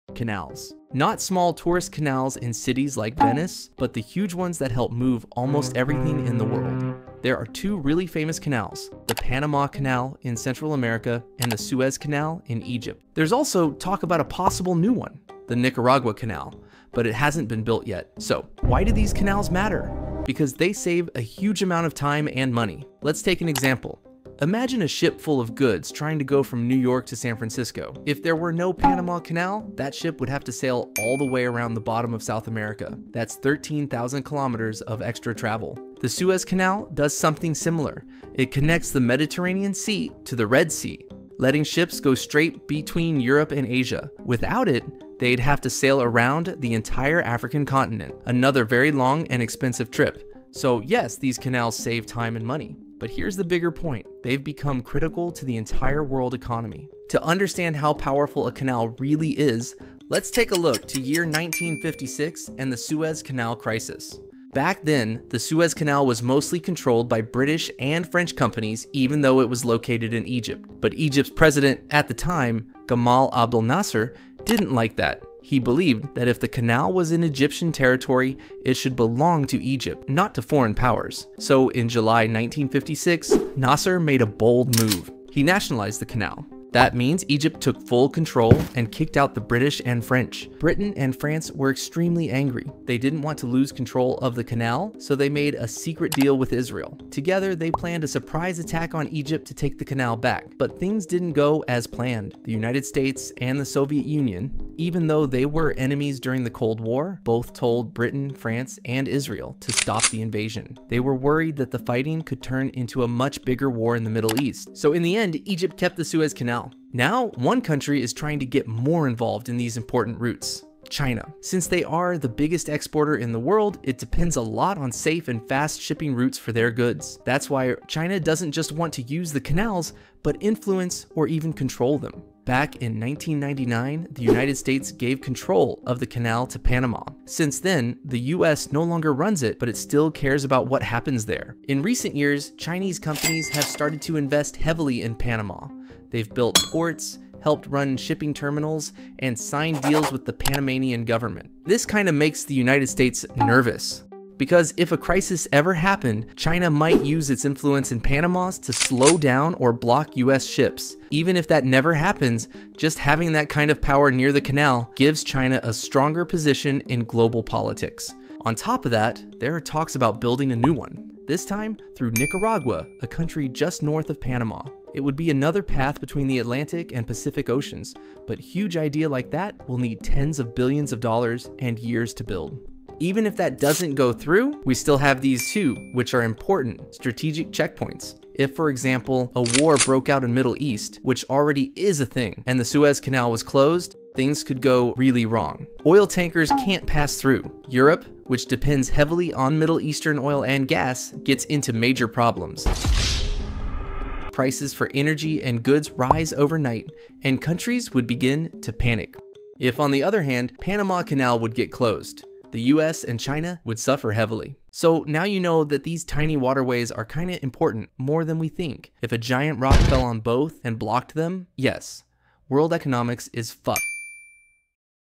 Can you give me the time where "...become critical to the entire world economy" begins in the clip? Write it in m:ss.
0:54.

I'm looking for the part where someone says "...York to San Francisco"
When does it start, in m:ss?
0:26.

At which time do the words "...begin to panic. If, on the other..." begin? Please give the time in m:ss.
3:28.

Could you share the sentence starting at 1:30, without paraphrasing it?
Britain and France were extremely angry.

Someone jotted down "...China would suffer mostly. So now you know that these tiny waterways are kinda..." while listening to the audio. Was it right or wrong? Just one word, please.
wrong.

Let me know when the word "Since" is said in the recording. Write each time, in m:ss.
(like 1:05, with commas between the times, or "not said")
2:01, 2:17.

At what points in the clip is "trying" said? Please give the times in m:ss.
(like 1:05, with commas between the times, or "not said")
0:25, 1:58.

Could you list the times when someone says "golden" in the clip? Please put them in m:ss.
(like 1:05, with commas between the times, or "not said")
not said.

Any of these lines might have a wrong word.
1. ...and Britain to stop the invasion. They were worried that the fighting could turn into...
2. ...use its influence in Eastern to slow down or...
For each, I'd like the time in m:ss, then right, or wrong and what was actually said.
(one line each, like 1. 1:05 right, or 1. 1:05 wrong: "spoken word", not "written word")
1. 1:48 wrong: "Israel", not "Britain"
2. 2:37 wrong: "Panama", not "Eastern".